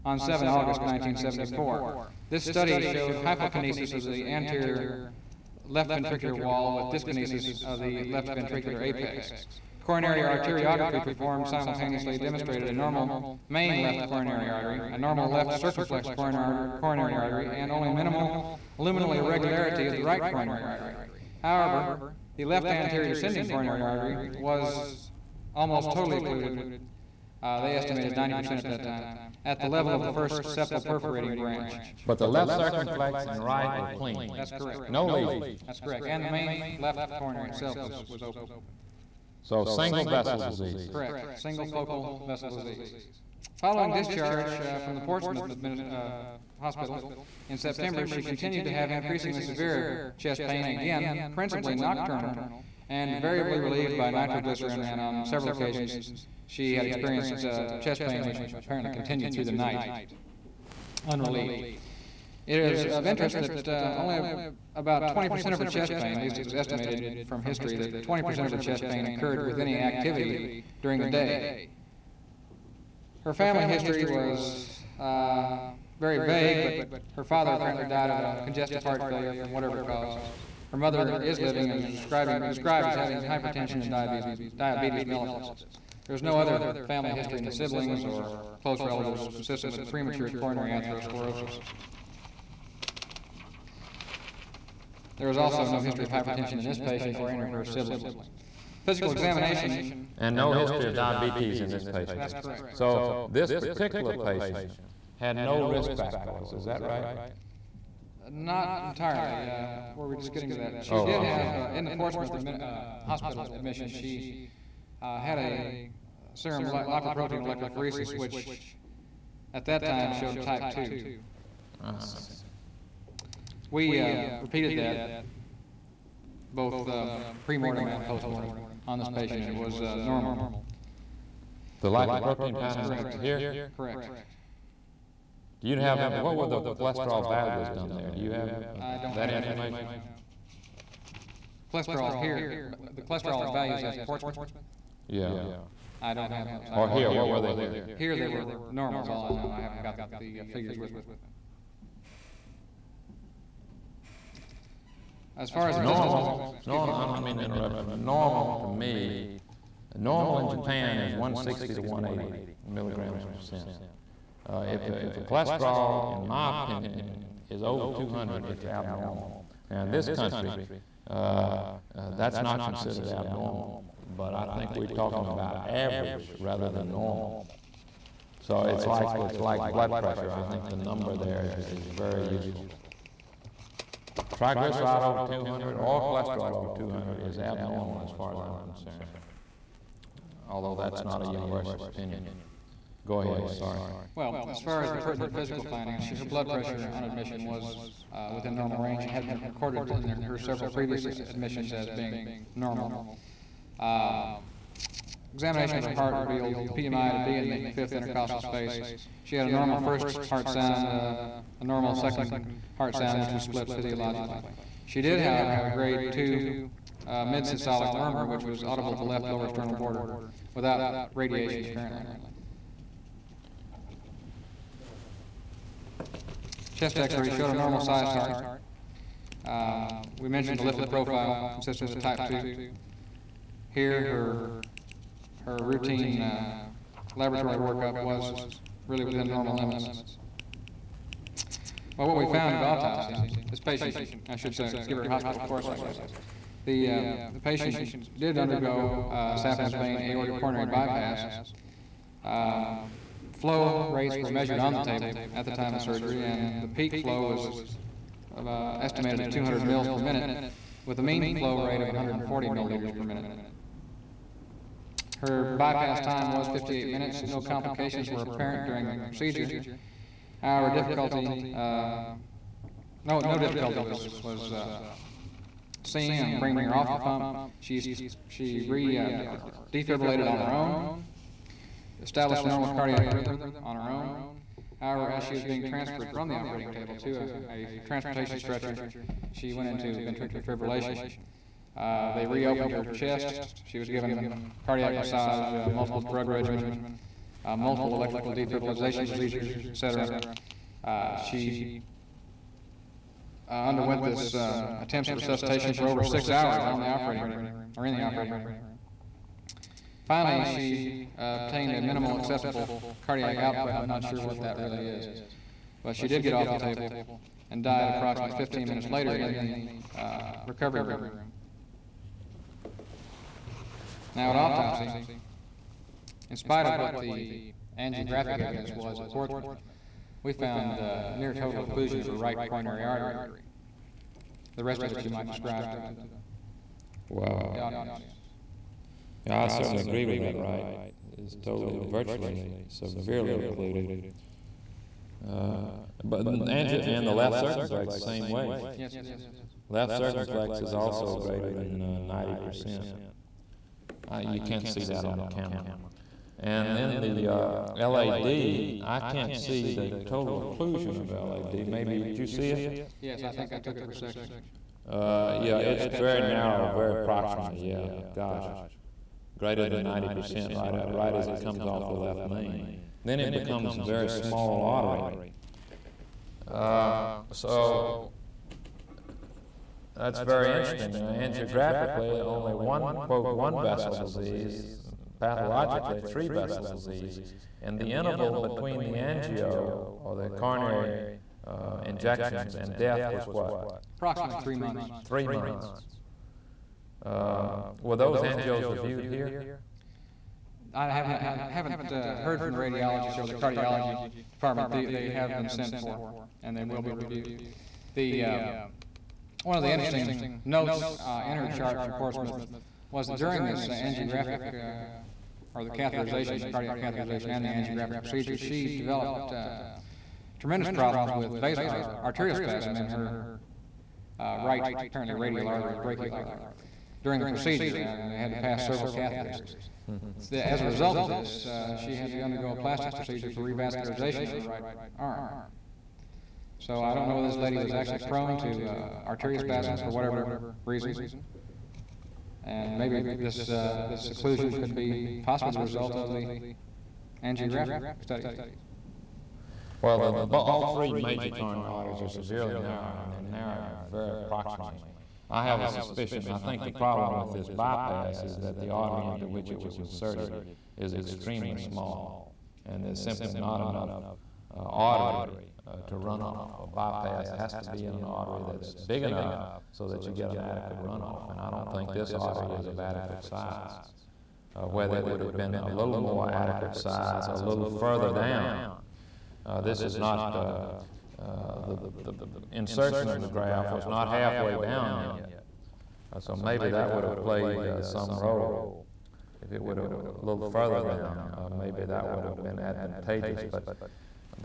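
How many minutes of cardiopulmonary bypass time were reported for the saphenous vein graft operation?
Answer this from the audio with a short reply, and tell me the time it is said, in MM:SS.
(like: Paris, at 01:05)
58 minutes, at 04:26.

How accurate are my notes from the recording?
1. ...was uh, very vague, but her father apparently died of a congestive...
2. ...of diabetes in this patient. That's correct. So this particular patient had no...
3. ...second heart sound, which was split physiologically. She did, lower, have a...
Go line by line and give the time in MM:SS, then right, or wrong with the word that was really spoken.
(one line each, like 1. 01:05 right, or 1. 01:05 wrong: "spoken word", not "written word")
1. 01:14 right
2. 01:40 right
3. 03:31 wrong: "however", not "lower".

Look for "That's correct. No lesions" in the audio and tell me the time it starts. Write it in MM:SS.
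00:34.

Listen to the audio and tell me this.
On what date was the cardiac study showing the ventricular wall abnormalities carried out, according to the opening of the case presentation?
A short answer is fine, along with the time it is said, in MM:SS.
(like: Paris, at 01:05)
7 August 1974, at 00:00.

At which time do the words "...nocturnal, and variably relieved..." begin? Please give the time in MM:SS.
00:51.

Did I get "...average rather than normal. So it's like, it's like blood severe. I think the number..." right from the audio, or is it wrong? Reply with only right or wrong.
wrong.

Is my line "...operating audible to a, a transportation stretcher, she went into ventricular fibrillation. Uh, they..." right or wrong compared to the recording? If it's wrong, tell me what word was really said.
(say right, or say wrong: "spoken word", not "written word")
wrong: "table", not "audible".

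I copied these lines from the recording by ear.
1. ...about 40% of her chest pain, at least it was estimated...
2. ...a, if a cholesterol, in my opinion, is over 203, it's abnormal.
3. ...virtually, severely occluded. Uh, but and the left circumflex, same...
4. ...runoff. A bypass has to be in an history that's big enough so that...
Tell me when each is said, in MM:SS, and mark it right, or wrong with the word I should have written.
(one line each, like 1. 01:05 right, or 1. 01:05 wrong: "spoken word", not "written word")
1. 01:04 wrong: "20", not "40"
2. 02:44 wrong: "200", not "203"
3. 05:41 right
4. 07:45 wrong: "artery", not "history".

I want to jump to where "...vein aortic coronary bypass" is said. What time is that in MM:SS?
04:09.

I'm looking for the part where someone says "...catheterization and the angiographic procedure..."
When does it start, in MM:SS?
06:56.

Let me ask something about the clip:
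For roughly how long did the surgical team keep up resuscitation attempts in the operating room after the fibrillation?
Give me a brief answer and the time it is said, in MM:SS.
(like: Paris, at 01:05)
over 6 hours, at 05:05.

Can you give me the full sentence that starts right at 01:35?
There is also no history of hypertension in this patient or any of her siblings.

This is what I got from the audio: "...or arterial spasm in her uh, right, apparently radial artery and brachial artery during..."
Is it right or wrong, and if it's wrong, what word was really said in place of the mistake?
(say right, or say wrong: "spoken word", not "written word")
right.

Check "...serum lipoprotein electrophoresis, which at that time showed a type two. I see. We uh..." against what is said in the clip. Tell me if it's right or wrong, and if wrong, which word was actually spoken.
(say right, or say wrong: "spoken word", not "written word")
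right.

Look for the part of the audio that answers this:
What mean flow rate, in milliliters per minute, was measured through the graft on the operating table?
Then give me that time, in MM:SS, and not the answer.
04:21.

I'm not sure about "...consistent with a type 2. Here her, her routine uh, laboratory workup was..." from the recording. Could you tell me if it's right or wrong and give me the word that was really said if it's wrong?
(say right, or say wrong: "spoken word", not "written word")
right.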